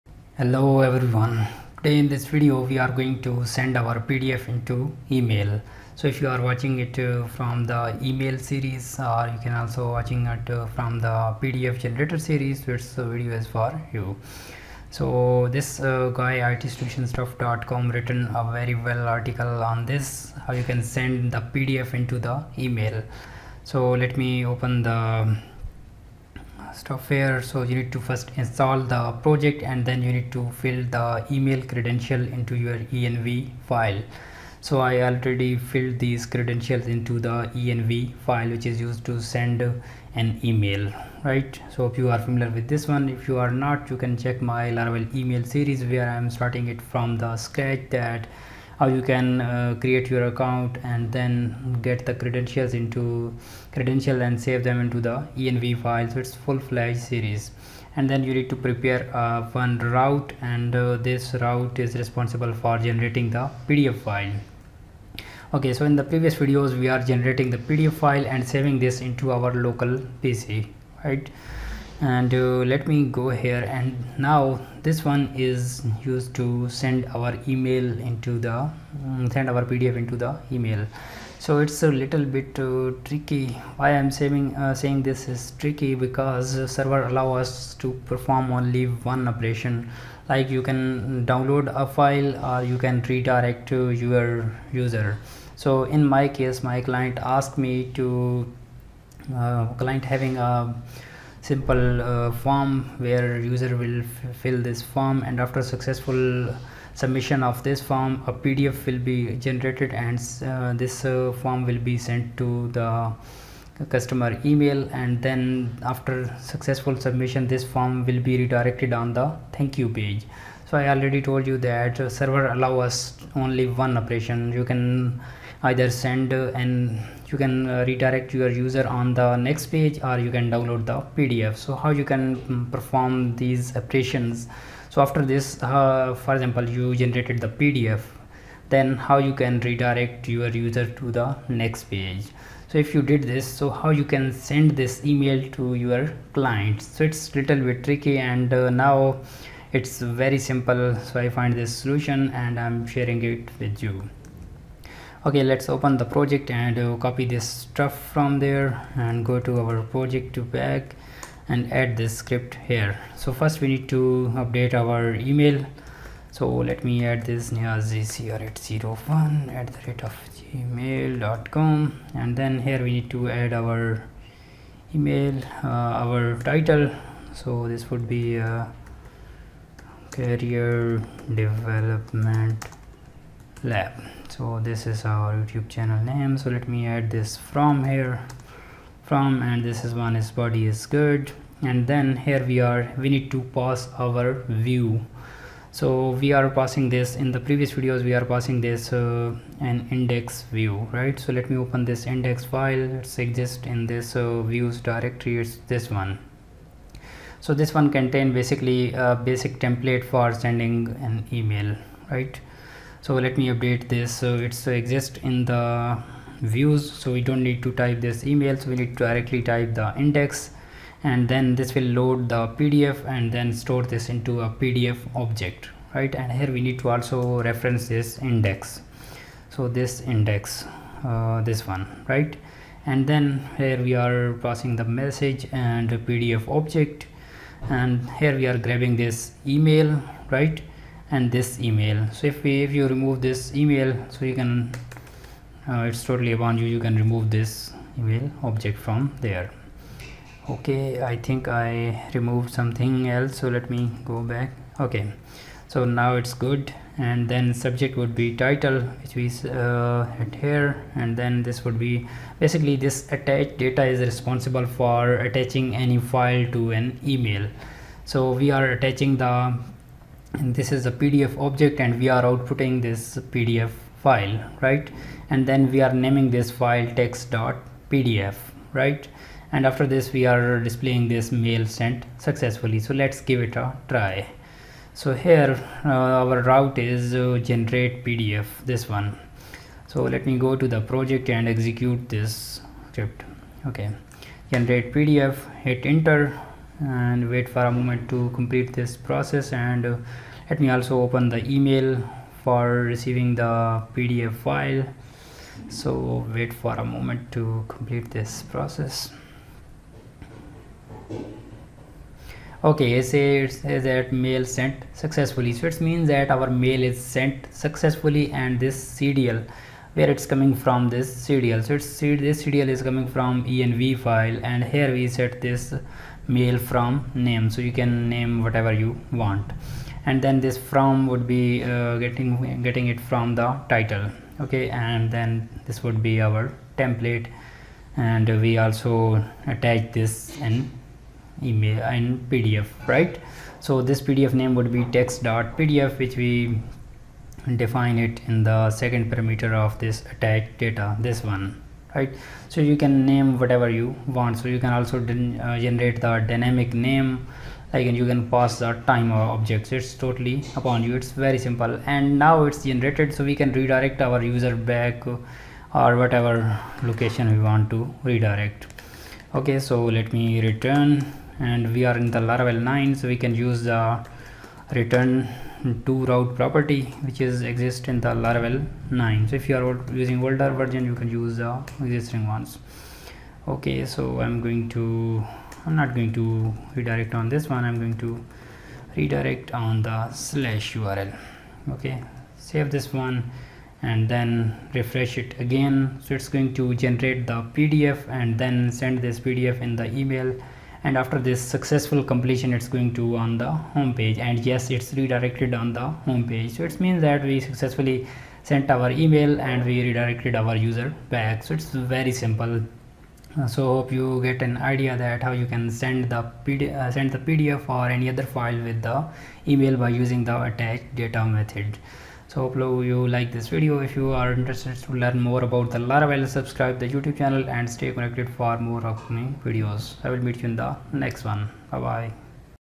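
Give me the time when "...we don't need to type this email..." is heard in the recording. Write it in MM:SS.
03:37.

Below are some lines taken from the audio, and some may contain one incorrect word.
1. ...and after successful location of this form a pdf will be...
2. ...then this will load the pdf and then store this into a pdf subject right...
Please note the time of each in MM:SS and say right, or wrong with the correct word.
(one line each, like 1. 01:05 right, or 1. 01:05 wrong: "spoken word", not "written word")
1. 01:45 wrong: "submission", not "location"
2. 03:41 wrong: "object", not "subject".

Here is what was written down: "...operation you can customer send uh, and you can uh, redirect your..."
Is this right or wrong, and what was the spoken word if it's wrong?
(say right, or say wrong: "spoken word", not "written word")
wrong: "either", not "customer".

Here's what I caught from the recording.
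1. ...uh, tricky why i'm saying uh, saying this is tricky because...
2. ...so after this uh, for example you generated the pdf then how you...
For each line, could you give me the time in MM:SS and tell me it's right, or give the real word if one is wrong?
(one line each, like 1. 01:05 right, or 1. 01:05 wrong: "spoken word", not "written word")
1. 01:22 right
2. 02:14 right.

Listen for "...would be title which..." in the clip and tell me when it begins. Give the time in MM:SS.
04:17.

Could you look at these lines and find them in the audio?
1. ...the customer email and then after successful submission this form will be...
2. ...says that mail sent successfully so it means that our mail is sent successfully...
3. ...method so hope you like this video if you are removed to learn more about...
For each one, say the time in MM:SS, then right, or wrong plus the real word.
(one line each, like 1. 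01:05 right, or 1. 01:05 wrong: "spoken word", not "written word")
1. 01:52 right
2. 05:13 right
3. 07:01 wrong: "interested", not "removed".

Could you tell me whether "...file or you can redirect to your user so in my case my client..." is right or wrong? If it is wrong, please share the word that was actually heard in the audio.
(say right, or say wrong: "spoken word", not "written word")
right.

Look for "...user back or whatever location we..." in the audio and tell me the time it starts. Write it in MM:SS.
06:04.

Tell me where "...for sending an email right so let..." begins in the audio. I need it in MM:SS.
03:30.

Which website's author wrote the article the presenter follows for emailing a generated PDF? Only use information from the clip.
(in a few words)
itsolutionstuff.com.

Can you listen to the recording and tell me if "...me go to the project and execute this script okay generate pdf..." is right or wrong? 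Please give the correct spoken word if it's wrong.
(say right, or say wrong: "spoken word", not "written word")
right.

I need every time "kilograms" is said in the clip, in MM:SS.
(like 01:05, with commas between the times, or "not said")
not said.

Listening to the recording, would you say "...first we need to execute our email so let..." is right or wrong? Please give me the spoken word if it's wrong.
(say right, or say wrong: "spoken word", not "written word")
wrong: "update", not "execute".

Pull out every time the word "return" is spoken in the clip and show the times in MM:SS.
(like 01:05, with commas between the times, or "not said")
06:10, 06:14.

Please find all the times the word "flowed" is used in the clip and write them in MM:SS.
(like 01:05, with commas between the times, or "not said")
not said.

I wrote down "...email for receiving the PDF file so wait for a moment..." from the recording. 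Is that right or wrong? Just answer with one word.
right.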